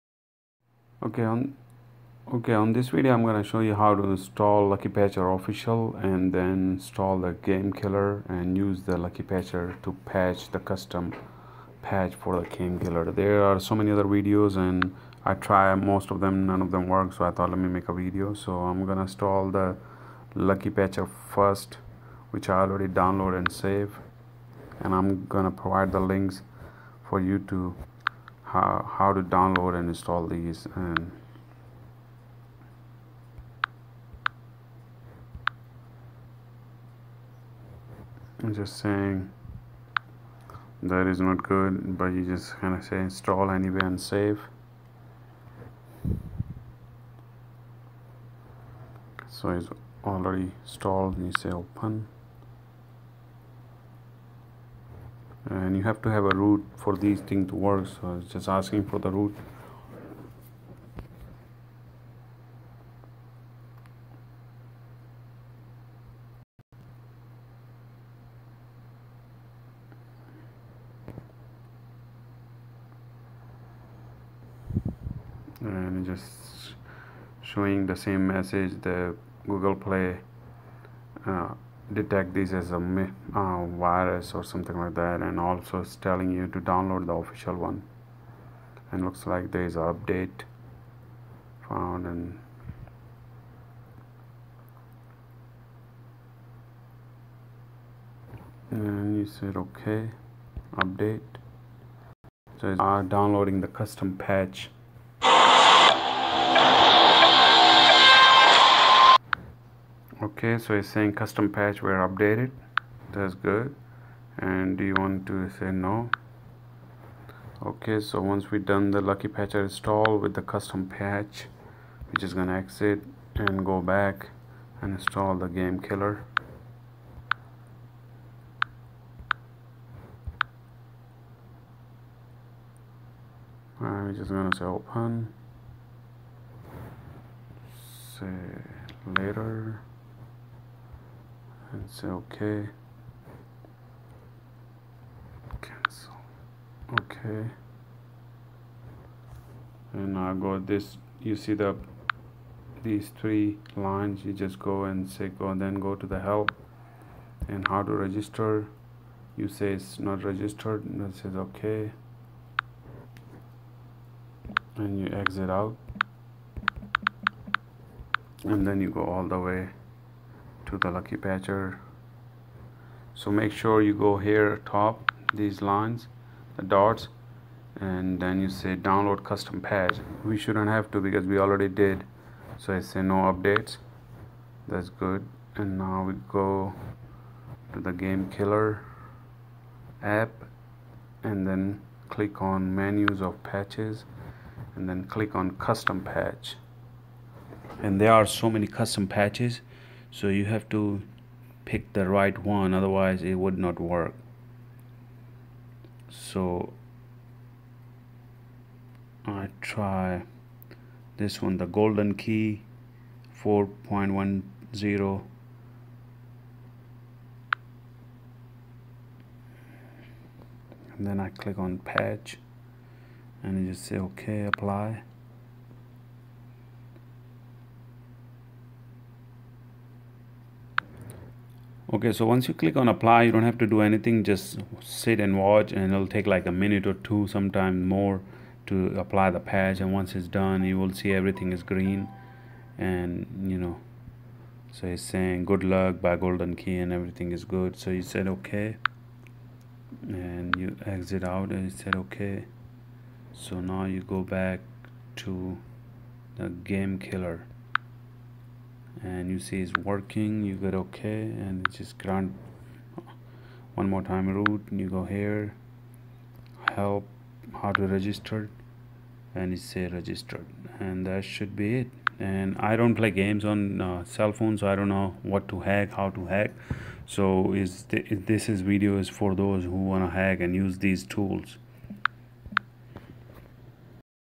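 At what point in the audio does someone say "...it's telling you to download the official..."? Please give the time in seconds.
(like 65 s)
85 s.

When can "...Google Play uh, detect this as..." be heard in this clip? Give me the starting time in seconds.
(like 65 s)
79 s.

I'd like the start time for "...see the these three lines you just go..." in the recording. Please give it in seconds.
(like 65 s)
151 s.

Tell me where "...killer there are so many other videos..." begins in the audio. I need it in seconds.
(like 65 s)
12 s.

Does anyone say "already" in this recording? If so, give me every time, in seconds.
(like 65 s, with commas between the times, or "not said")
22 s, 50 s, 181 s.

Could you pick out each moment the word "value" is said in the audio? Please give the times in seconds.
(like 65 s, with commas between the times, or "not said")
not said.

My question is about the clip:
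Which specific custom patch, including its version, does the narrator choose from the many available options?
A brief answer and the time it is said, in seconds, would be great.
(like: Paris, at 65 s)
Golden Key 4.10, at 211 s.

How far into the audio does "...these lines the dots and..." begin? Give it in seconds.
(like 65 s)
175 s.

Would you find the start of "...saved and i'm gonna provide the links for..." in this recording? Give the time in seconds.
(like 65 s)
23 s.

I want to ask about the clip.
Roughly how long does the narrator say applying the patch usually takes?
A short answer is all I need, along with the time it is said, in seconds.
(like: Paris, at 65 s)
A minute or two, at 236 s.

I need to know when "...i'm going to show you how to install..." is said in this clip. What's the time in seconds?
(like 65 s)
3 s.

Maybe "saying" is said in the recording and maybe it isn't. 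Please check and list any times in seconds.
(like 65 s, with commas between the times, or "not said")
38 s, 110 s, 245 s.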